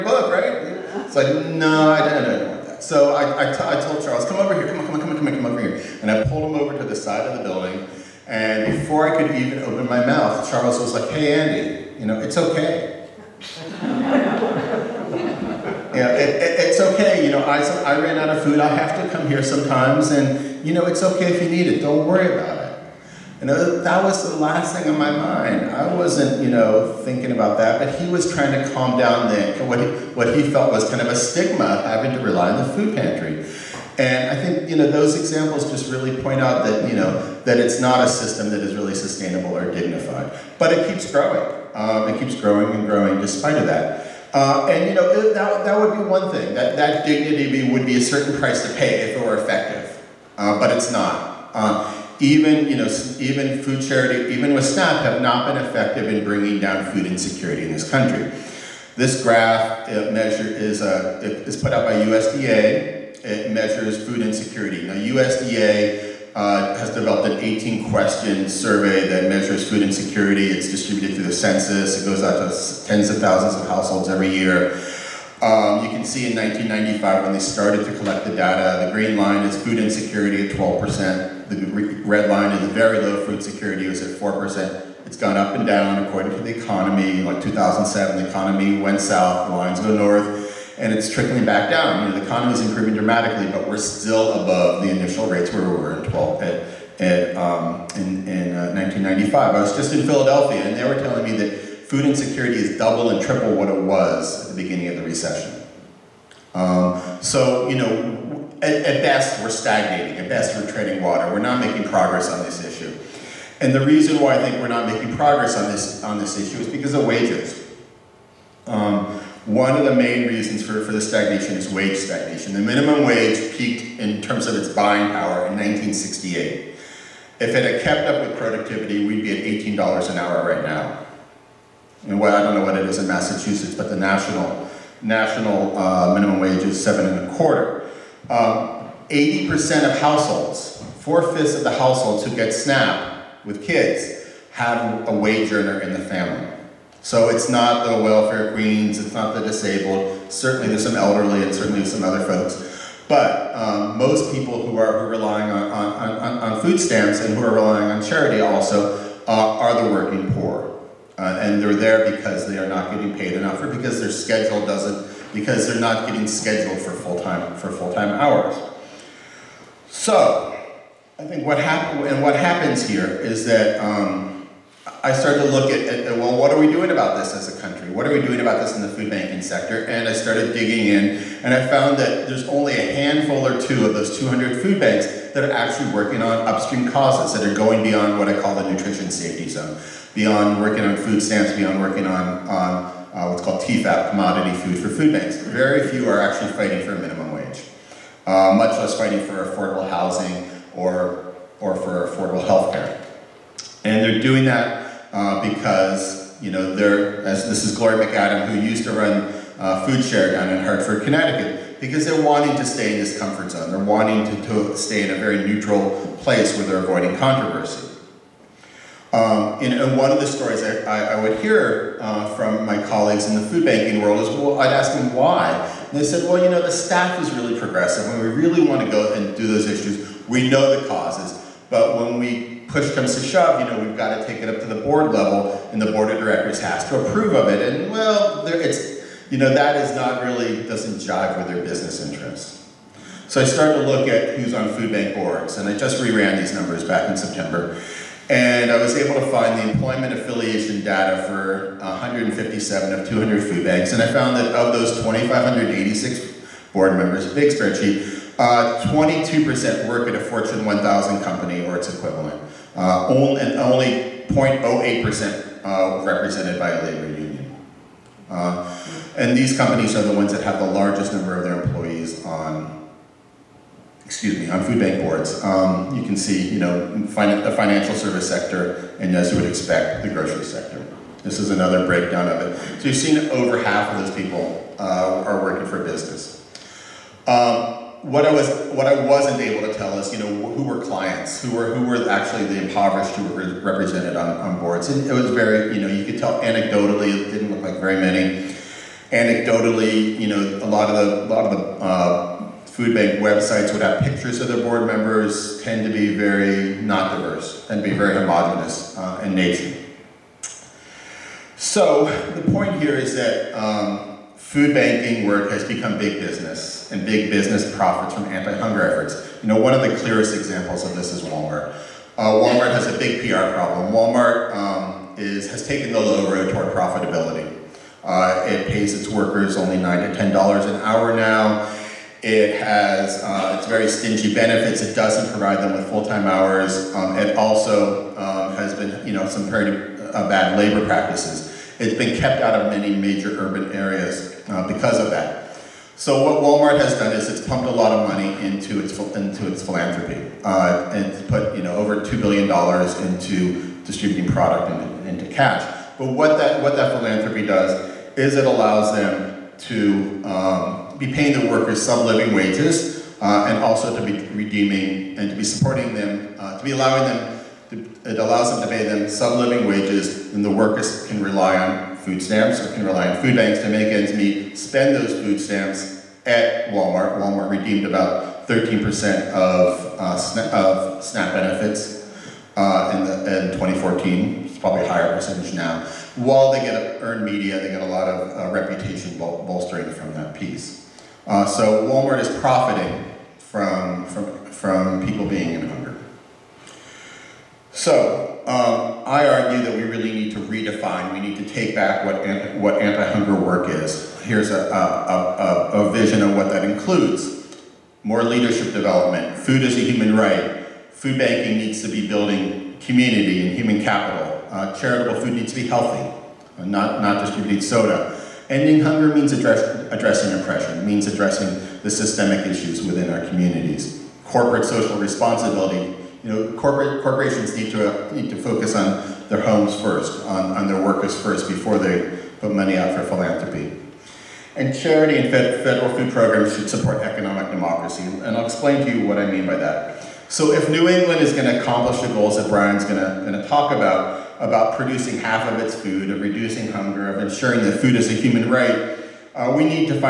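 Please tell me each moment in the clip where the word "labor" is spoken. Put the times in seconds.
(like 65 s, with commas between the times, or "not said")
266 s, 340 s.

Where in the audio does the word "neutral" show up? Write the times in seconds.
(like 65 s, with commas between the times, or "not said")
215 s.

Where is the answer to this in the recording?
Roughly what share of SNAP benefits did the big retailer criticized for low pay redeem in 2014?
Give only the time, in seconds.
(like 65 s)
378 s.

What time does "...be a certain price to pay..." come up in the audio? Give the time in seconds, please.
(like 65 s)
47 s.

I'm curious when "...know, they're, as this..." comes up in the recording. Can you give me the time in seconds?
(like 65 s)
206 s.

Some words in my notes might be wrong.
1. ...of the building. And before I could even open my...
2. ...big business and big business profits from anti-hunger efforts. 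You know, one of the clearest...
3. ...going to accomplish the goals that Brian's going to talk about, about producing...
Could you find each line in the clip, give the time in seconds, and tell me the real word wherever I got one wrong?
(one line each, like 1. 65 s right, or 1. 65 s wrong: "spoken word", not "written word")
1. 7 s right
2. 315 s right
3. 441 s right.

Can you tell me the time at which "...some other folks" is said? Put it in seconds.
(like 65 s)
151 s.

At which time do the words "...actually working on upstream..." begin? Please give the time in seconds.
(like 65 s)
185 s.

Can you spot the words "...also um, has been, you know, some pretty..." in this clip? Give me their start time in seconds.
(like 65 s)
337 s.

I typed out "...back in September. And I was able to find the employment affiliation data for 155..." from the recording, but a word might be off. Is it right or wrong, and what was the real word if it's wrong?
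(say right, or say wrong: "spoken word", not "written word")
wrong: "157", not "155".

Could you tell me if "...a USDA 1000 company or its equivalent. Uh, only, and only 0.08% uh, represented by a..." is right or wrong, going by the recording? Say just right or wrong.
wrong.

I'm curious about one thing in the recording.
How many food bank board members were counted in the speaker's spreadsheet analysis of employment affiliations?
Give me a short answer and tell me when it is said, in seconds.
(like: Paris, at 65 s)
2,586, at 255 s.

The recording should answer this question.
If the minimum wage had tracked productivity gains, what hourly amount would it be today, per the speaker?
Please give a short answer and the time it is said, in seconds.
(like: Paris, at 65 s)
$18 an hour, at 129 s.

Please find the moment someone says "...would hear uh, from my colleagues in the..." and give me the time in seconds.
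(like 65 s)
221 s.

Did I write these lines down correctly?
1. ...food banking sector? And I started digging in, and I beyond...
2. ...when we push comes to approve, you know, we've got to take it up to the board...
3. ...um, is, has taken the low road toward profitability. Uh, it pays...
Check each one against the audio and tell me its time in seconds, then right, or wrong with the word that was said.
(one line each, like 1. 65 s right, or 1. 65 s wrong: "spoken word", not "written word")
1. 178 s wrong: "found", not "beyond"
2. 231 s wrong: "shove", not "approve"
3. 324 s right.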